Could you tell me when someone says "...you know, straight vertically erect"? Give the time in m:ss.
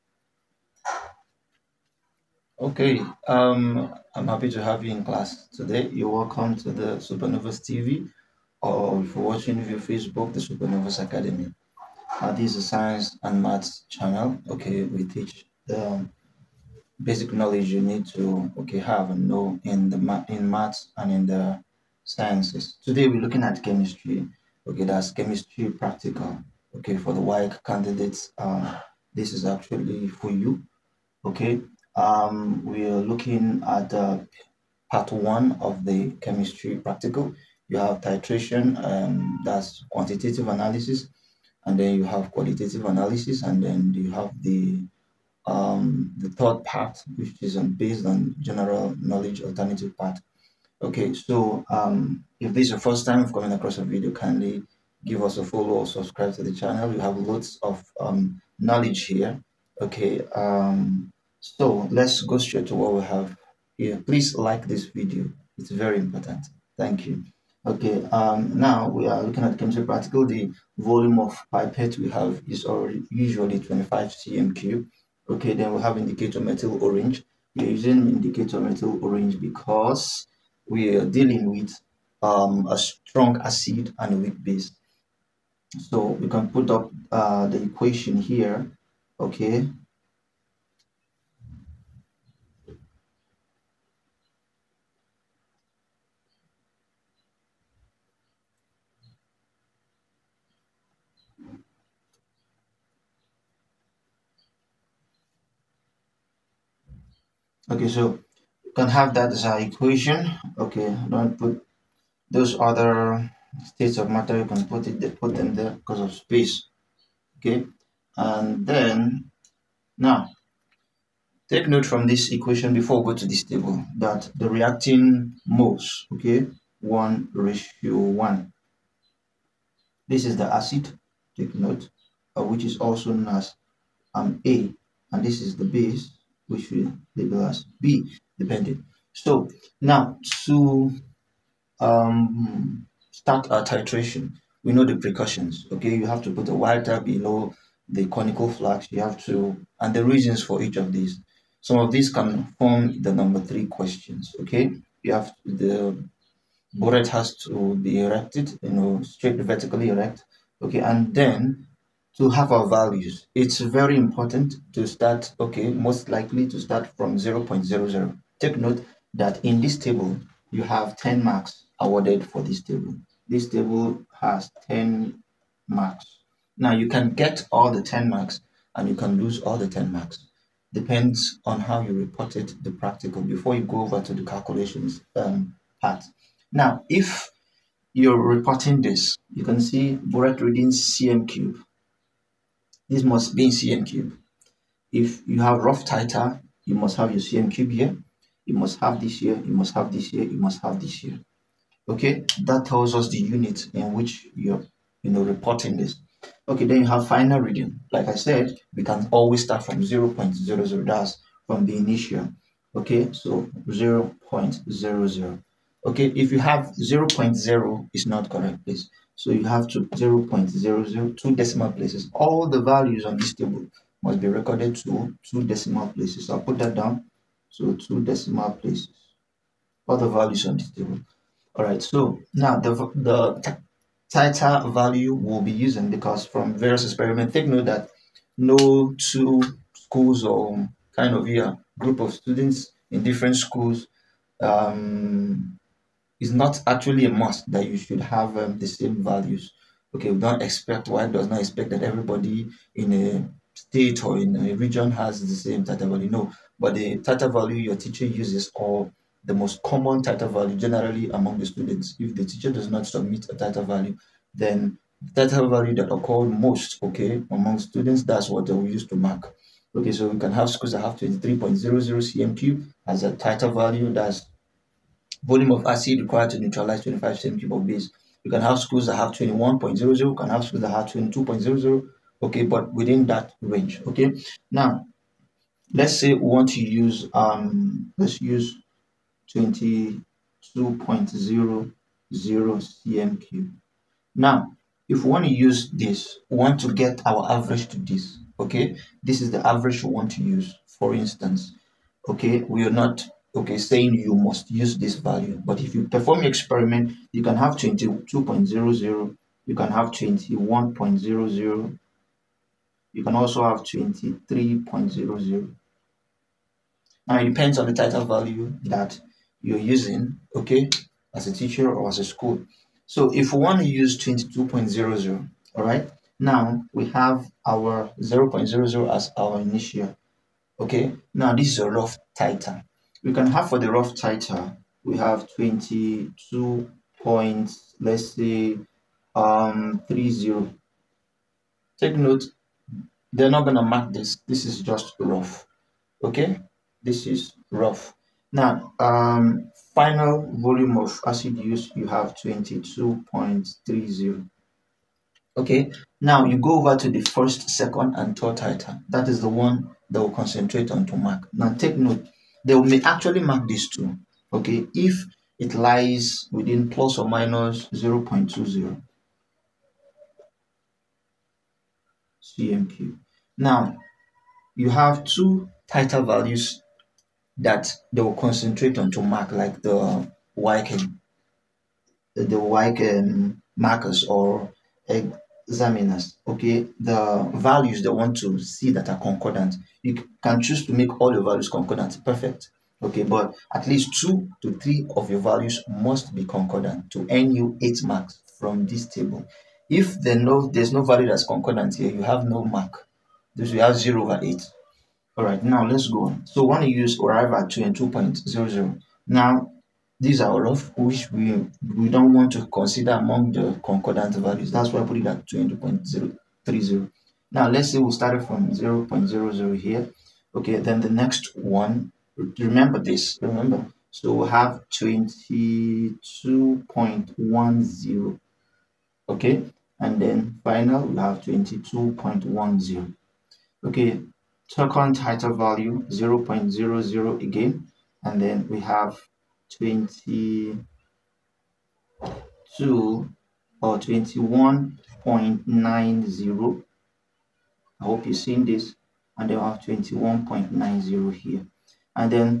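2:38.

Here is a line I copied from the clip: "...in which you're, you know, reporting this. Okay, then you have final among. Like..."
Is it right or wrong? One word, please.
wrong.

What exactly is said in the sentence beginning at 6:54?
That's why I put it at 20.030.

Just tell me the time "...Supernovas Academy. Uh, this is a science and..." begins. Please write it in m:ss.
0:10.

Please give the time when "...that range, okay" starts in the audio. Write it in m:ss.
4:43.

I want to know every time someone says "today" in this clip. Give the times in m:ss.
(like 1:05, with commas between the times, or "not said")
0:05, 0:22.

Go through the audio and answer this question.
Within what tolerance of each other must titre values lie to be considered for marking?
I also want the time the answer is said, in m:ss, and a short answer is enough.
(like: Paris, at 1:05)
plus or minus 0.20 cm³, at 6:06.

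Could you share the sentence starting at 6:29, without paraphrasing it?
You can choose to make all your values concordant, perfect.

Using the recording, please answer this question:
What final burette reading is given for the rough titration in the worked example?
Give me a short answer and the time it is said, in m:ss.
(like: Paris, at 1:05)
22.30, at 5:52.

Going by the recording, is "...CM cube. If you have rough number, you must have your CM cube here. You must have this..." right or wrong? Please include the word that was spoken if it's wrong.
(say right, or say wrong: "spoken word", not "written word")
wrong: "titer", not "number".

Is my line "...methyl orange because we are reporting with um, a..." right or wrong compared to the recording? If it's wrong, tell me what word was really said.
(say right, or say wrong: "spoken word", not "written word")
wrong: "dealing", not "reporting".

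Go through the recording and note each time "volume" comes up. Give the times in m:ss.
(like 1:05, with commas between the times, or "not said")
1:10, 4:35, 5:50.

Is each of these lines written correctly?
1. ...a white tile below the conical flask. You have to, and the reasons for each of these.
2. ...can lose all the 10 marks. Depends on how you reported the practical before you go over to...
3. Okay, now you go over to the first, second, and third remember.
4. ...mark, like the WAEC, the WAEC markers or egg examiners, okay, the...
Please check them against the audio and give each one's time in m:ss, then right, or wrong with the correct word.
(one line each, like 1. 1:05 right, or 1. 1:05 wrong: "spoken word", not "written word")
1. 2:26 right
2. 2:58 right
3. 5:55 wrong: "titer", not "remember"
4. 6:19 right.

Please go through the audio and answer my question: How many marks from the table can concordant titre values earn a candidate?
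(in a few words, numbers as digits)
8.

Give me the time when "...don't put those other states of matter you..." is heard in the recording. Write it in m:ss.
1:51.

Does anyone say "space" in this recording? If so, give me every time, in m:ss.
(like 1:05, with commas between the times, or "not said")
1:56.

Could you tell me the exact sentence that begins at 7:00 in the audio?
Okay, then the next one, remember this, remember.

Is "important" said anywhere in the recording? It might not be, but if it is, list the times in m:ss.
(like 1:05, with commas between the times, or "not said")
1:05, 2:43.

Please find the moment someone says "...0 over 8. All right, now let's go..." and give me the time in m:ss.
6:43.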